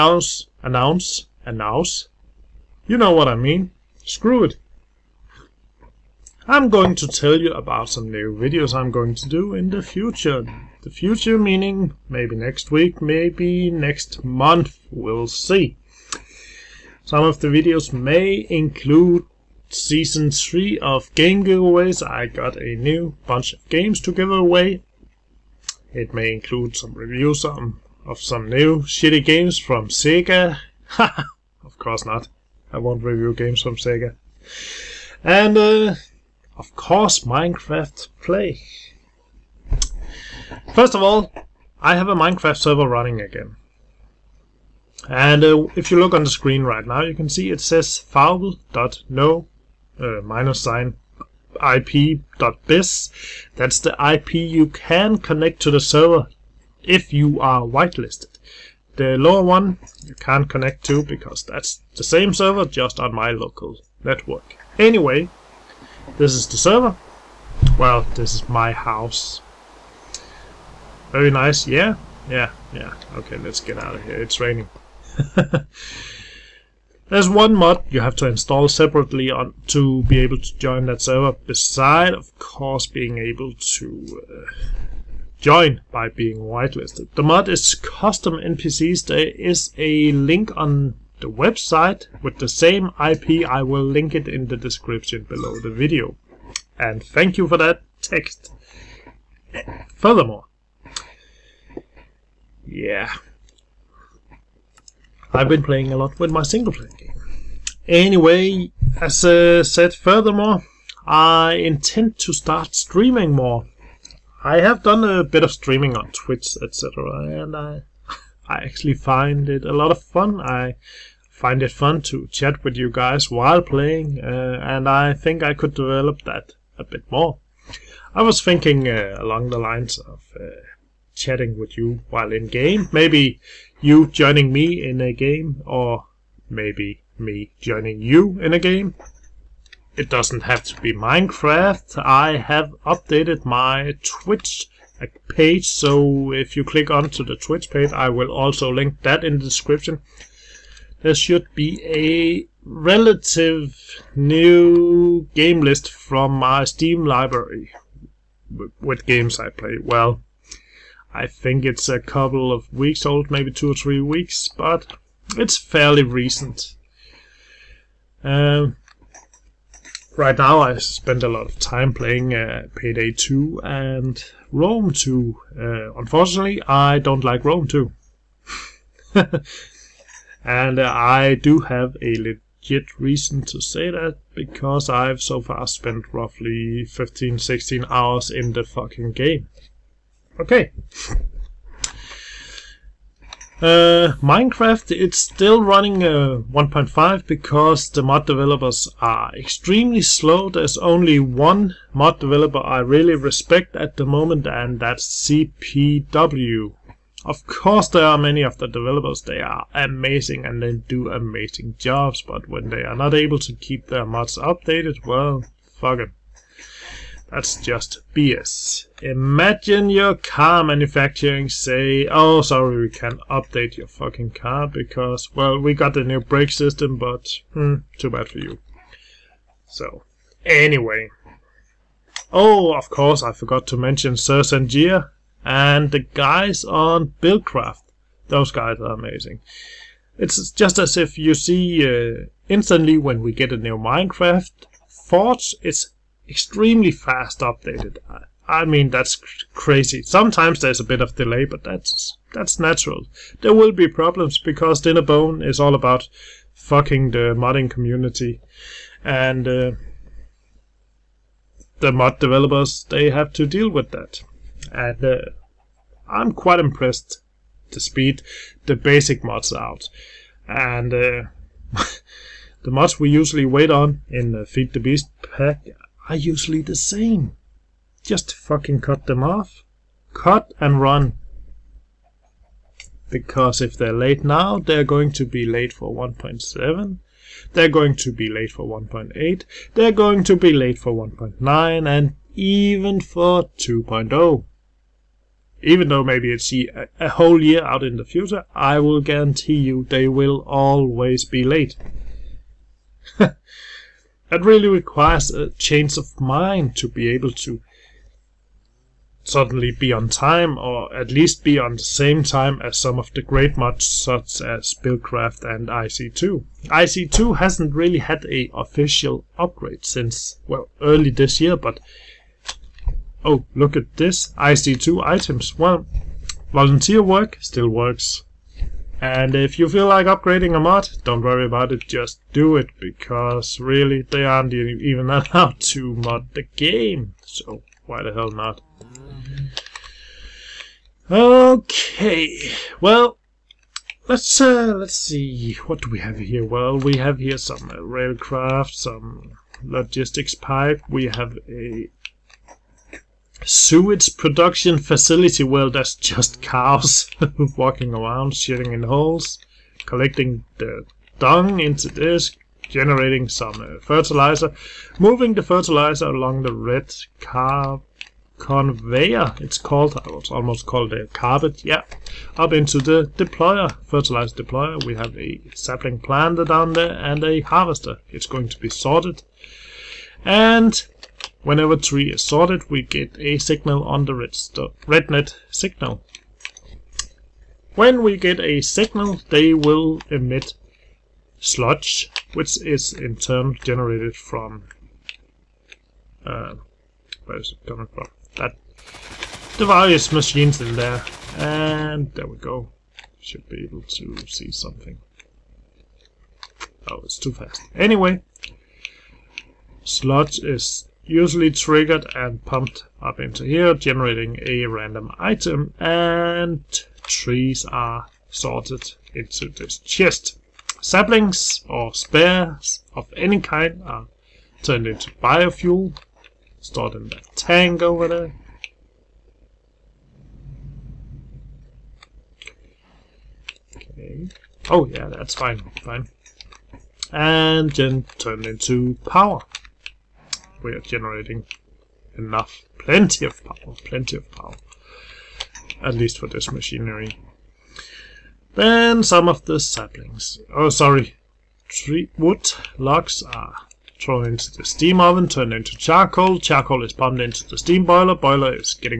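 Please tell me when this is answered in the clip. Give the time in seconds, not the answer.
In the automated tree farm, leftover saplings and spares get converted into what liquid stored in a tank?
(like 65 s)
425 s.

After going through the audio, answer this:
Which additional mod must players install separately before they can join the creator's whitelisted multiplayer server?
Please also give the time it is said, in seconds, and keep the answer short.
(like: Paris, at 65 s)
Custom NPCs, at 87 s.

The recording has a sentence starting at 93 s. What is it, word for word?
I will link it in the description below the video.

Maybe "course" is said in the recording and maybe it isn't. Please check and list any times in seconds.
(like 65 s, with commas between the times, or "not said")
31 s, 36 s, 82 s, 207 s, 232 s.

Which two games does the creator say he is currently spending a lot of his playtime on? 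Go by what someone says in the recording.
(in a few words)
Payday 2 and Rome 2.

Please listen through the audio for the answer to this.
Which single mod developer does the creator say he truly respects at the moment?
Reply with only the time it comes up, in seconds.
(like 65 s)
205 s.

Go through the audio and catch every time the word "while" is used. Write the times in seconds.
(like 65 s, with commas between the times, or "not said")
123 s, 132 s.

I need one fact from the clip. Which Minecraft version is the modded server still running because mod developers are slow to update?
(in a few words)
1.5.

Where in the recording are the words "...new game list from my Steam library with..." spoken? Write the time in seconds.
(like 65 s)
154 s.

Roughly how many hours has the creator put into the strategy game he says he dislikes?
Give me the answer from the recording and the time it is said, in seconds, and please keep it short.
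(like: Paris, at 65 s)
15-16 hours, at 186 s.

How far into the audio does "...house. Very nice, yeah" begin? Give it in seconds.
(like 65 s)
68 s.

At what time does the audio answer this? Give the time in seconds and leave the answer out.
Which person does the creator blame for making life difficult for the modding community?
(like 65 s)
254 s.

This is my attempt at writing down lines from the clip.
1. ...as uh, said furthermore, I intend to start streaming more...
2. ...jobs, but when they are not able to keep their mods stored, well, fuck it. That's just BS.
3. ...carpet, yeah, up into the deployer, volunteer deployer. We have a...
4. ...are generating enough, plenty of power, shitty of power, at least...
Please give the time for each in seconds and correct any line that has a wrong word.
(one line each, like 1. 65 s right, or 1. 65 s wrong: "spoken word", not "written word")
1. 109 s right
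2. 211 s wrong: "updated", not "stored"
3. 371 s wrong: "fertilizer", not "volunteer"
4. 440 s wrong: "plenty", not "shitty".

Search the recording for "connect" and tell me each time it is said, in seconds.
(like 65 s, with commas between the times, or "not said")
55 s, 60 s.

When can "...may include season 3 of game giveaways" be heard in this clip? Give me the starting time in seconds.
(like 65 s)
17 s.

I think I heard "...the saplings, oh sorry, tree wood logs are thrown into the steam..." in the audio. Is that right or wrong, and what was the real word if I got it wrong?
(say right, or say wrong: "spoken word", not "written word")
right.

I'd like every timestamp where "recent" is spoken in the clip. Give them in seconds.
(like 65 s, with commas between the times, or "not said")
166 s.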